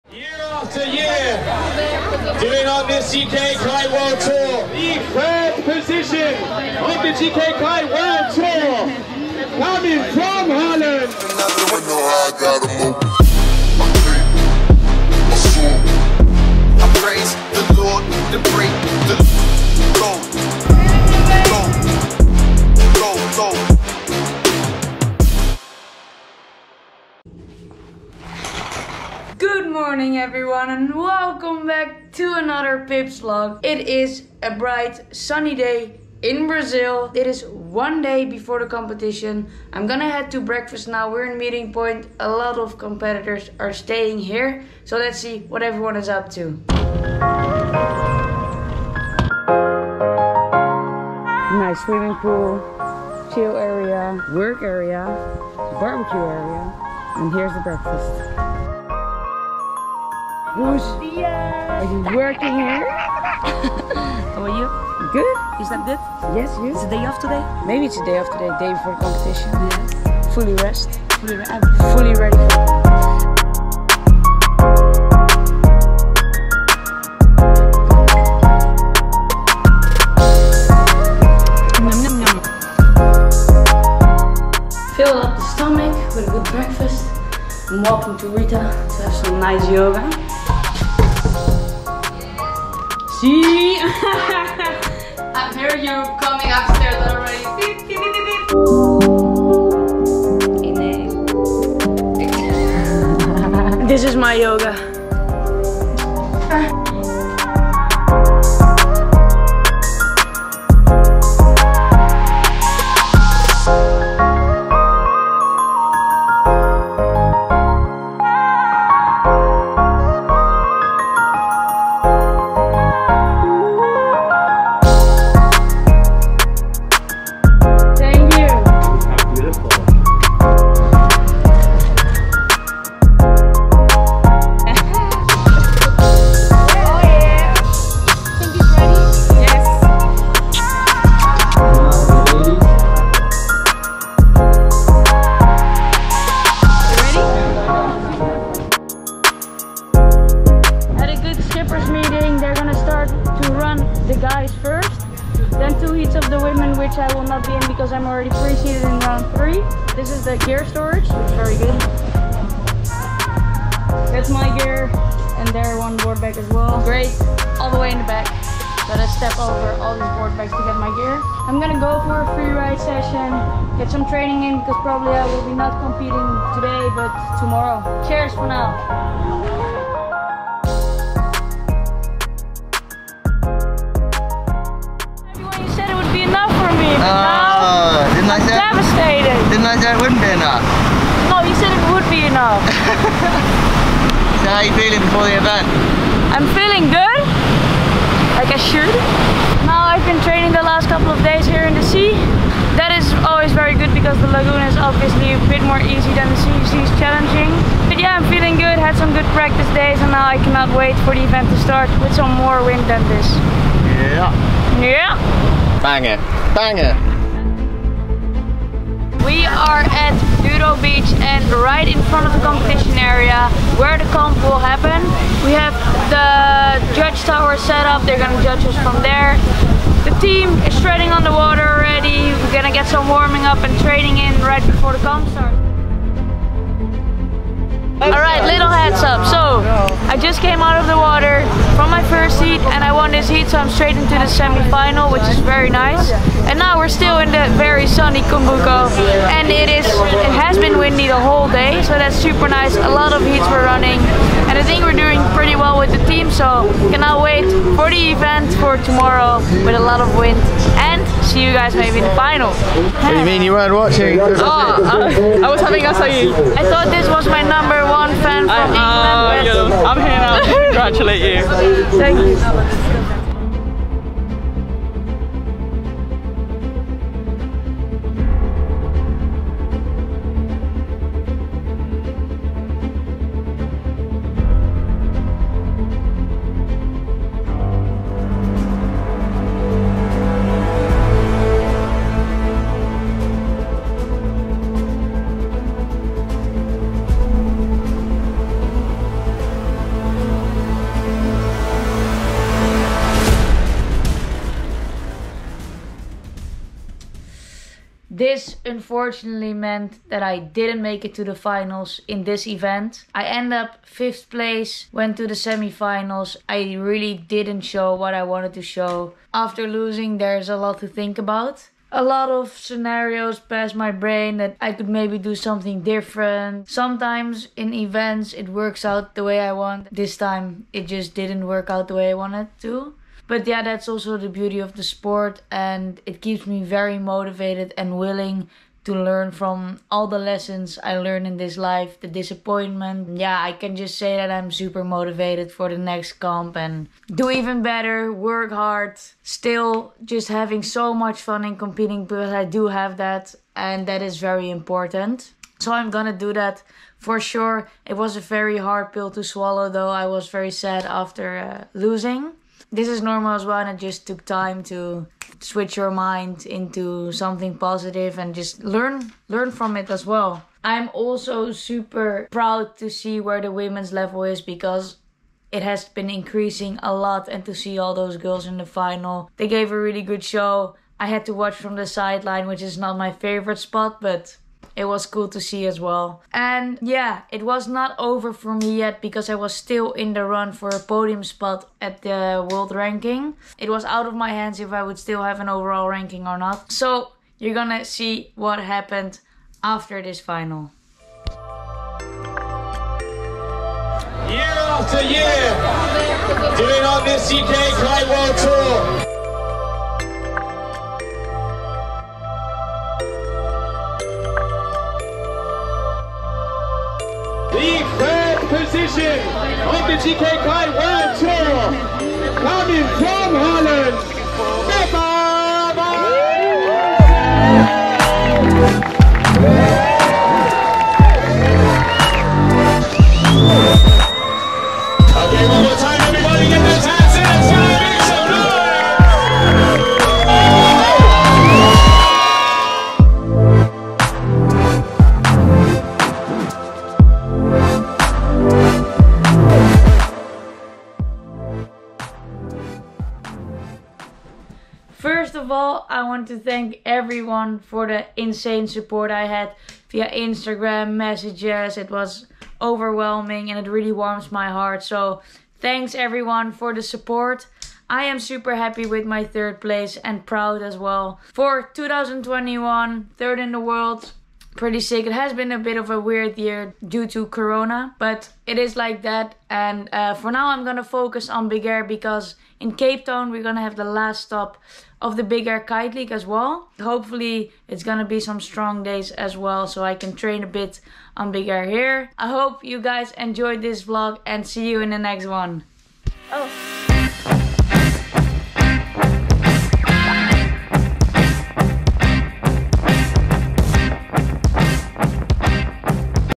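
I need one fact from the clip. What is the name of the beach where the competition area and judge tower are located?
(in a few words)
Dudo Beach.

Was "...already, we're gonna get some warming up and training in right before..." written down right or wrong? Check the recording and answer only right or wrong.
right.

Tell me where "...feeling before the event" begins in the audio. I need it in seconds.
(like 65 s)
194 s.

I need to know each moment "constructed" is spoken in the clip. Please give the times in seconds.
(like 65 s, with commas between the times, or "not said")
not said.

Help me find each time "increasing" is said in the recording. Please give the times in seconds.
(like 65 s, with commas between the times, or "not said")
376 s.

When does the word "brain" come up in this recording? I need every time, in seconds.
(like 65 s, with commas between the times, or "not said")
323 s.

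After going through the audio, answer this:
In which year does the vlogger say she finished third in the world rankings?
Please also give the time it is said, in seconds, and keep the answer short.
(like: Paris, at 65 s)
2021, at 471 s.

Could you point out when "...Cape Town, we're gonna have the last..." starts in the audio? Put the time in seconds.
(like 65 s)
482 s.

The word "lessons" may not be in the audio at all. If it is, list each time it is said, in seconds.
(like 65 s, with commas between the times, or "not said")
340 s.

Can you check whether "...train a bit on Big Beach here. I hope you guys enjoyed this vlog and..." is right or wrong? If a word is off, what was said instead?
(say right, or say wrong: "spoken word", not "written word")
wrong: "Air", not "Beach".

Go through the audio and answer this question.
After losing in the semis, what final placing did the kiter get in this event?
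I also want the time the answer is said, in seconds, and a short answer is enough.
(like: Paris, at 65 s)
5th, at 313 s.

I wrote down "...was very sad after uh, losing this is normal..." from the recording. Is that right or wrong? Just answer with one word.
right.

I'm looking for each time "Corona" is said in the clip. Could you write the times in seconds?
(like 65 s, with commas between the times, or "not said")
477 s.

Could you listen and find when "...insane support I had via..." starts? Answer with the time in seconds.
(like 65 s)
458 s.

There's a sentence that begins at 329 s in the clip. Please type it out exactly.
This time it just didn't work out the way I wanted to.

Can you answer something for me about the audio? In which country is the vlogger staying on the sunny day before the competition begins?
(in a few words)
Brazil.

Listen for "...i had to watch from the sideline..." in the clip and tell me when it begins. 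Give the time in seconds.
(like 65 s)
380 s.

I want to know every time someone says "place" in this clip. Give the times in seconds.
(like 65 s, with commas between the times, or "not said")
314 s, 469 s.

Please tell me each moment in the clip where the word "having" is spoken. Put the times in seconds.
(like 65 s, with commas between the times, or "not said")
265 s, 350 s.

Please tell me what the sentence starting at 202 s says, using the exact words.
That is always very good because the lagoon is obviously a bit more easy than the sea.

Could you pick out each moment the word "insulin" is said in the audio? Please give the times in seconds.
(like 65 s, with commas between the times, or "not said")
not said.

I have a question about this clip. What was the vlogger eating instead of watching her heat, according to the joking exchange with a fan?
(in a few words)
acai.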